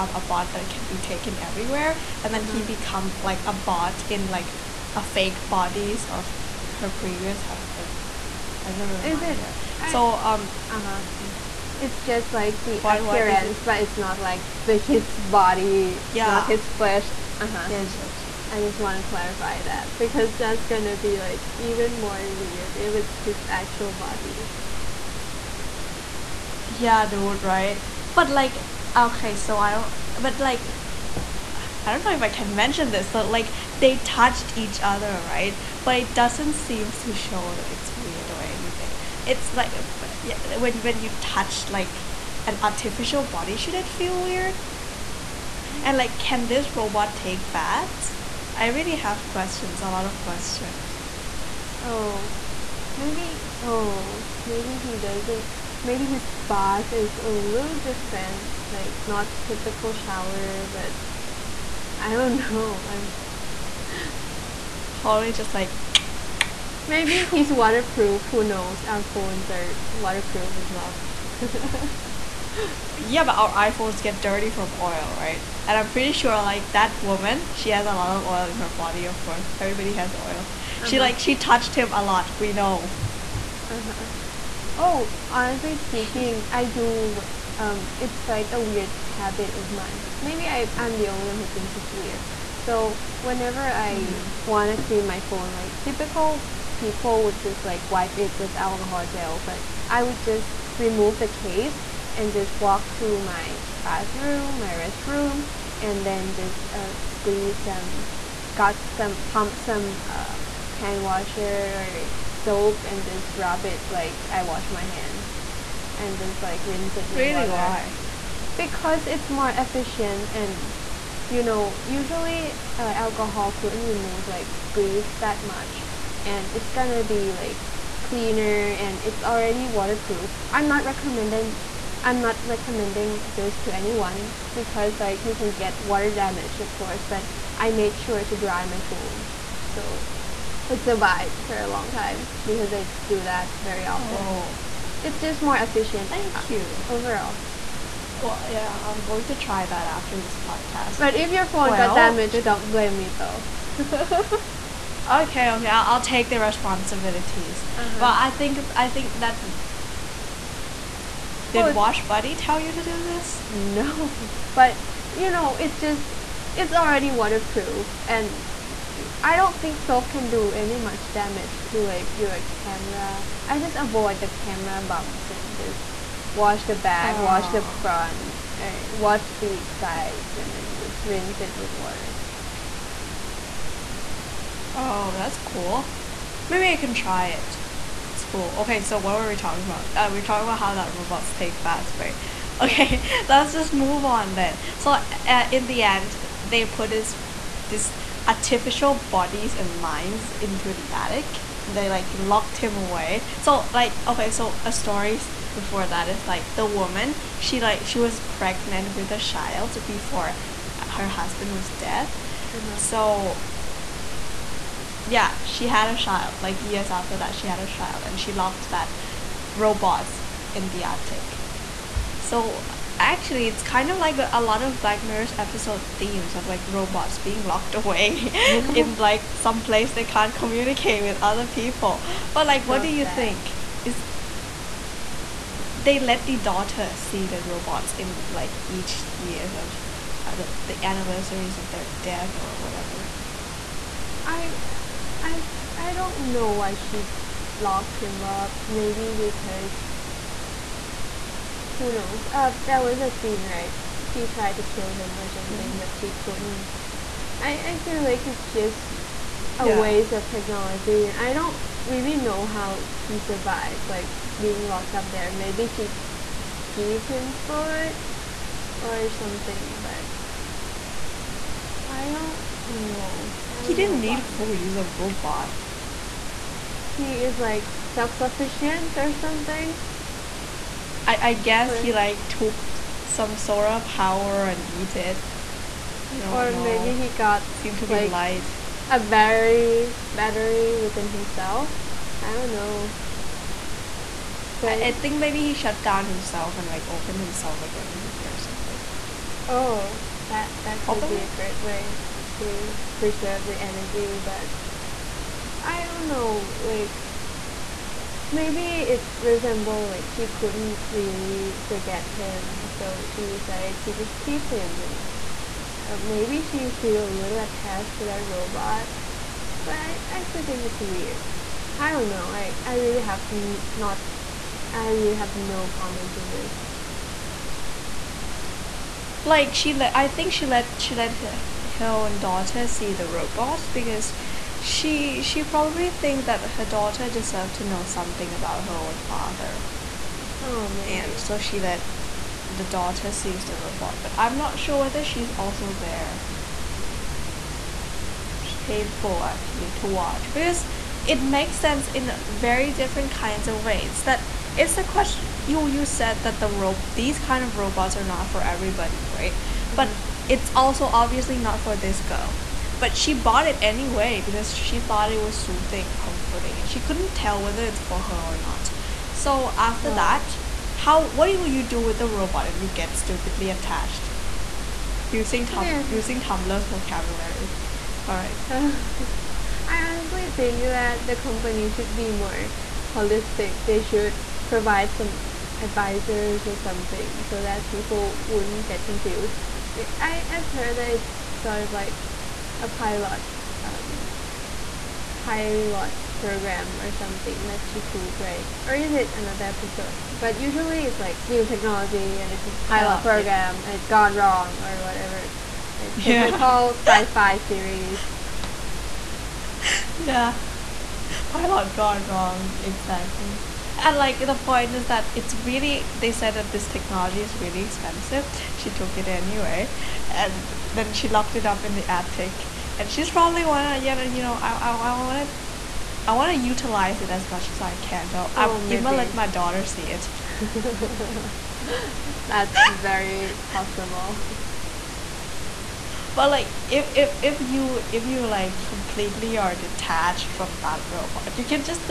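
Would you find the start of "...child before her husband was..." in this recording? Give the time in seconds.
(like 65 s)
209 s.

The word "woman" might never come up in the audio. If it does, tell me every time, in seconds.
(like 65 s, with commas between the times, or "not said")
77 s, 206 s.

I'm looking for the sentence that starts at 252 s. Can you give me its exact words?
Uh, that was a scene, right?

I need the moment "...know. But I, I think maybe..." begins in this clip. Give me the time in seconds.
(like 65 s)
292 s.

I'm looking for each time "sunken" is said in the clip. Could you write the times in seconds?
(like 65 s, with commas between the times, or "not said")
not said.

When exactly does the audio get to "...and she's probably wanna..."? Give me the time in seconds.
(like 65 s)
422 s.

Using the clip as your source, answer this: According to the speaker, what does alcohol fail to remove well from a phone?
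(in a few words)
Grease.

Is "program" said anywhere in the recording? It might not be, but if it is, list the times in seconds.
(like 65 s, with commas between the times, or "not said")
396 s, 403 s.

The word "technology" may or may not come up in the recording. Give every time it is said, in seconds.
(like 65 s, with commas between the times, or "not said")
260 s, 401 s, 416 s.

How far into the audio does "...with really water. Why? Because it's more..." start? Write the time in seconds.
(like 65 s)
117 s.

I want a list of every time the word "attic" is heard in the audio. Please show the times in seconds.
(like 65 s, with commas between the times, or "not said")
200 s, 220 s, 421 s.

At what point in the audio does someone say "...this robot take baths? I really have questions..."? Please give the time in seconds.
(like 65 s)
46 s.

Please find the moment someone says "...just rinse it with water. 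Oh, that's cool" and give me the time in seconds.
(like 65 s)
180 s.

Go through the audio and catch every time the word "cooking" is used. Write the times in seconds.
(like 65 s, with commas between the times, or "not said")
not said.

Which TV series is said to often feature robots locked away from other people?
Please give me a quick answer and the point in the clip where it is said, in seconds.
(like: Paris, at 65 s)
Black Mirror, at 224 s.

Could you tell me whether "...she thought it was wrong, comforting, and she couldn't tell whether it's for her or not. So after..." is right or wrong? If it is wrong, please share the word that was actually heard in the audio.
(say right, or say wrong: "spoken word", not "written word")
wrong: "soothing", not "wrong".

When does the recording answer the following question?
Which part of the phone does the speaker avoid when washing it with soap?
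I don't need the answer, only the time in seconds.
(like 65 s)
174 s.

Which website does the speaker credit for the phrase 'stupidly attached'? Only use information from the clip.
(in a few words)
Tumblr.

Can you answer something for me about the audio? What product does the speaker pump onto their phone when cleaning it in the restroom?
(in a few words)
Hand washer.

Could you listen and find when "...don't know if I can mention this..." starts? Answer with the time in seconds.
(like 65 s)
31 s.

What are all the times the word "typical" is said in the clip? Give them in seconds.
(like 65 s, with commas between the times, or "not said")
59 s, 95 s, 406 s.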